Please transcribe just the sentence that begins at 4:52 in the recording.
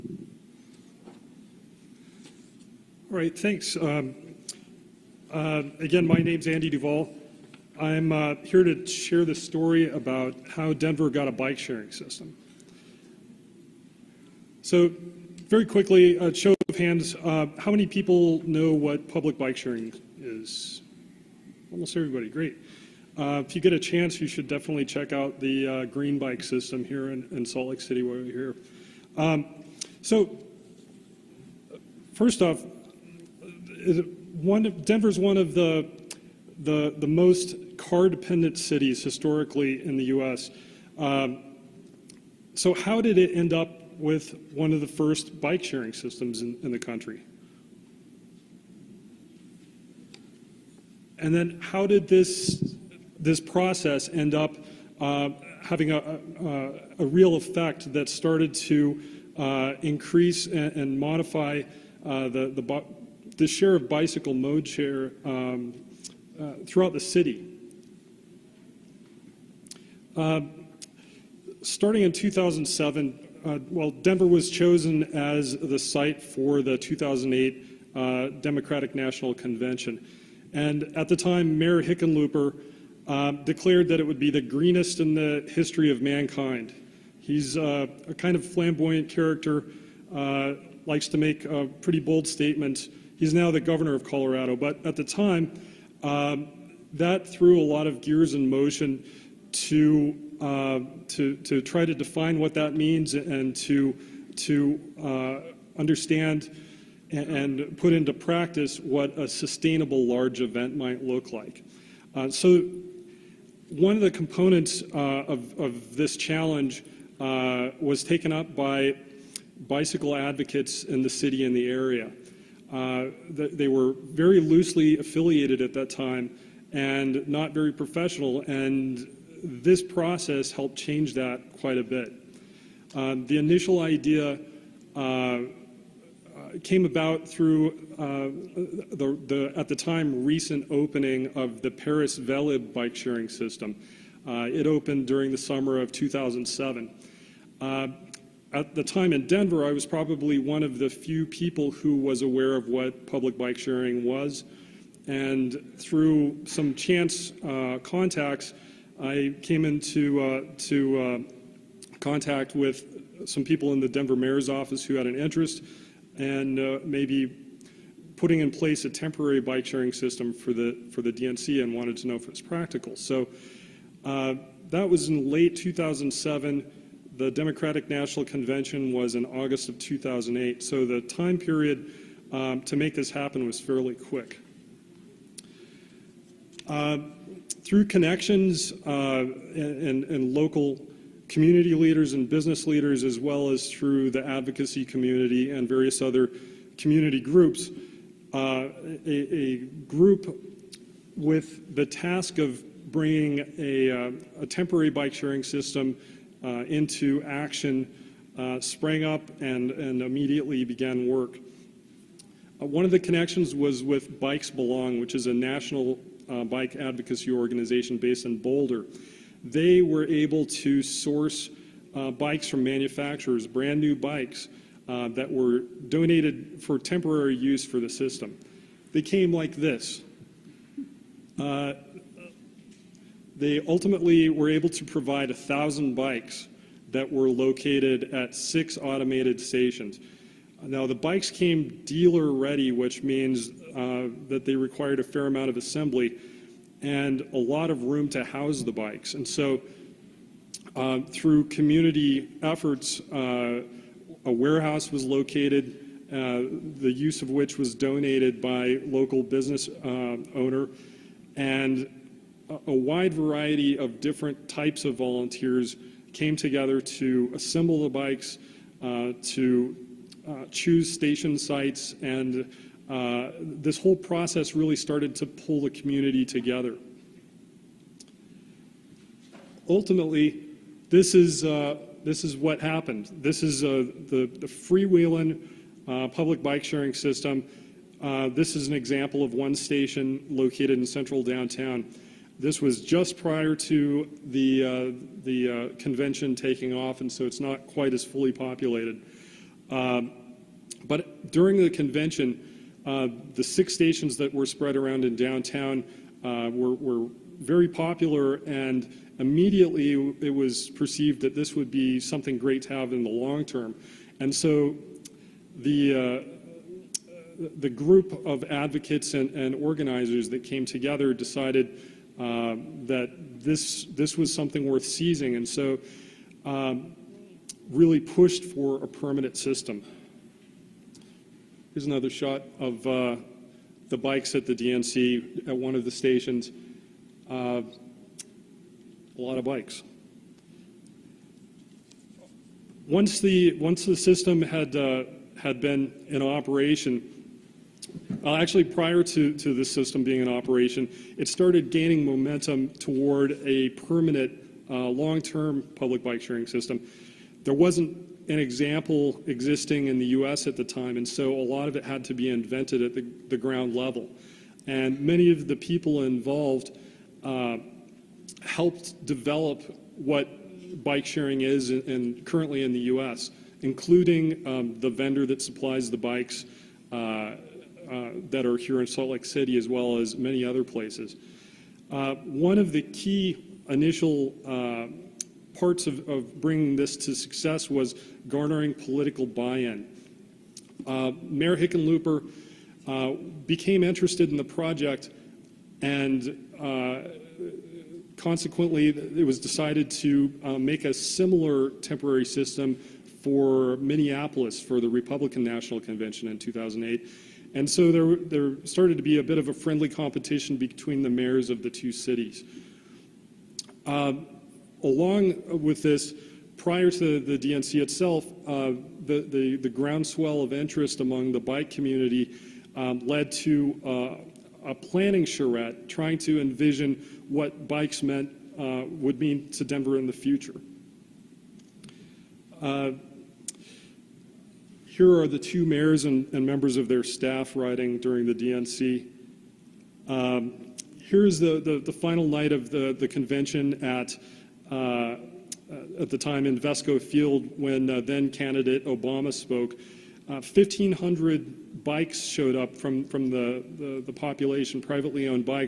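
This was just prior to the, uh, the uh, convention taking off, and so it's not quite as fully populated.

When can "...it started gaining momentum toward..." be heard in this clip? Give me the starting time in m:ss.
5:51.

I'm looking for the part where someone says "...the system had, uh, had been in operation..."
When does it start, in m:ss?
5:43.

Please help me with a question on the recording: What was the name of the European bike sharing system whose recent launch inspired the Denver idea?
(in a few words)
Velib.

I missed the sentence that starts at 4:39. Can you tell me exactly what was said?
Ultimately, this is, uh, this is what happened.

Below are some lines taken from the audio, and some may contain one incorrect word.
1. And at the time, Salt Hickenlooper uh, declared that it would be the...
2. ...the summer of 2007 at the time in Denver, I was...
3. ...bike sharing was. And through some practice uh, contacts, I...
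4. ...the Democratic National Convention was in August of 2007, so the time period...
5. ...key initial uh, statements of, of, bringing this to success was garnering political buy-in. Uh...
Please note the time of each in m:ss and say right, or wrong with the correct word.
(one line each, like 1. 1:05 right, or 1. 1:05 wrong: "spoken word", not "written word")
1. 1:20 wrong: "Mayor", not "Salt"
2. 2:25 right
3. 2:33 wrong: "chance", not "practice"
4. 2:57 wrong: "2008", not "2007"
5. 6:22 wrong: "parts", not "statements".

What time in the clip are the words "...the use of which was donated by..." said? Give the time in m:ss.
4:16.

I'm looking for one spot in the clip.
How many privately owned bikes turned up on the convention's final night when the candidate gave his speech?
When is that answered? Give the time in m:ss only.
7:30.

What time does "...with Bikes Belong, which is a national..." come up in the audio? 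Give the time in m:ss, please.
3:33.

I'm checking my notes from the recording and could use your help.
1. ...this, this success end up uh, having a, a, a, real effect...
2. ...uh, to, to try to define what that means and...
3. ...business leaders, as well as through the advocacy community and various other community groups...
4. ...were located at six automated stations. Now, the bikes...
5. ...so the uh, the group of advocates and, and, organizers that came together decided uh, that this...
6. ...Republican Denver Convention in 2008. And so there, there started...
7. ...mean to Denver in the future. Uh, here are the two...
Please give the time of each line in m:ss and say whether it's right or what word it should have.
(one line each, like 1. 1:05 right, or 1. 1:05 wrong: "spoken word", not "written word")
1. 0:52 wrong: "process", not "success"
2. 1:40 right
3. 3:12 right
4. 3:57 right
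5. 5:14 right
6. 6:44 wrong: "National", not "Denver"
7. 7:09 right.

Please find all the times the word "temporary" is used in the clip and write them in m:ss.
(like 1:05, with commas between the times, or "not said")
2:48, 3:24, 3:46, 6:41.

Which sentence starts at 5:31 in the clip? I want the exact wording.
Here's another shot of uh, the bikes at the DNC at one of the stations.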